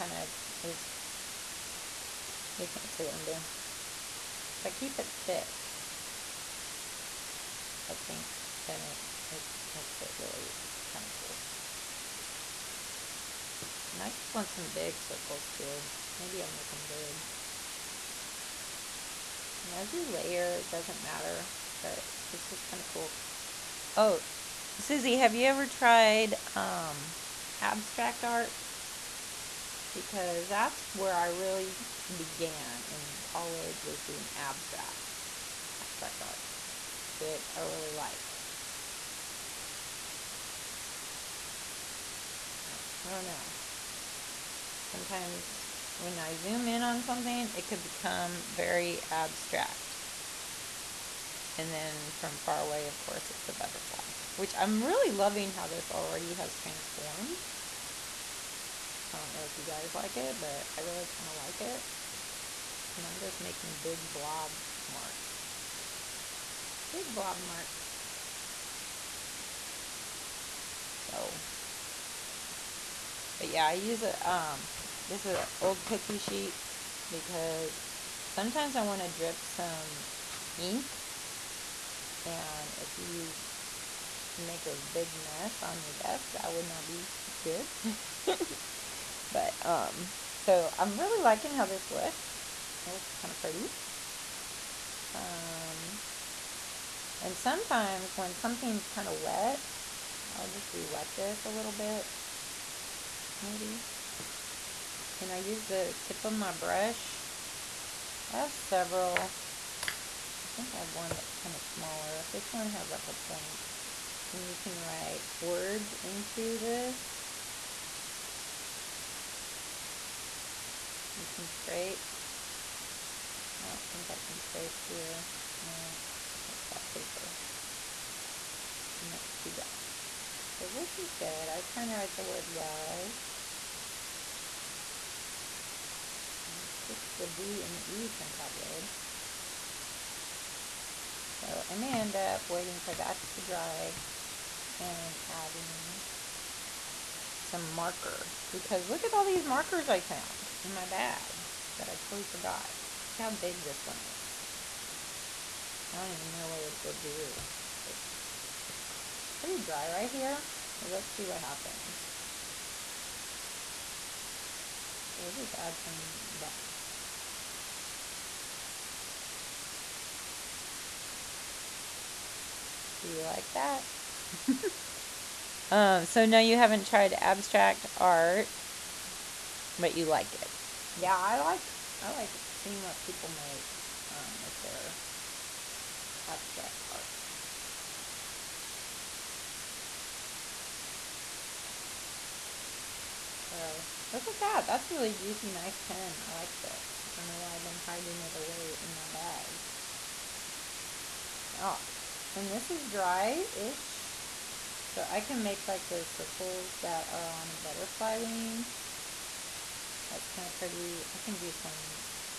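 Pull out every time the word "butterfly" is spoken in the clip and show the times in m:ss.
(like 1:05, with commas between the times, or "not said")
0:53, 3:27.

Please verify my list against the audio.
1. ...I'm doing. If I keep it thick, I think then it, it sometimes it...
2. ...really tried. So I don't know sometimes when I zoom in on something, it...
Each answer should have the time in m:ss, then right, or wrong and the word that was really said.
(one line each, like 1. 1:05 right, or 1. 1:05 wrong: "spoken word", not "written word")
1. 0:03 wrong: "makes", not "sometimes"
2. 0:37 wrong: "liked", not "tried".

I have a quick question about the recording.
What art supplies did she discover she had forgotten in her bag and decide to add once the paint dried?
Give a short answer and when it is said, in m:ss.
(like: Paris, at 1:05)
Markers, at 2:29.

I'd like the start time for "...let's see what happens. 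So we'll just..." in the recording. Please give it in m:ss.
2:40.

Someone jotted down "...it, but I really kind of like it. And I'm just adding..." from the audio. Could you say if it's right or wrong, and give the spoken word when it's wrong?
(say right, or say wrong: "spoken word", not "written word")
wrong: "making", not "adding".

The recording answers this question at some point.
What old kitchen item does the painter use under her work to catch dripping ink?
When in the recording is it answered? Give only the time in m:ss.
1:15.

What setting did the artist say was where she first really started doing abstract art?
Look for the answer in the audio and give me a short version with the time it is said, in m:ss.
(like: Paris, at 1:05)
College, at 0:33.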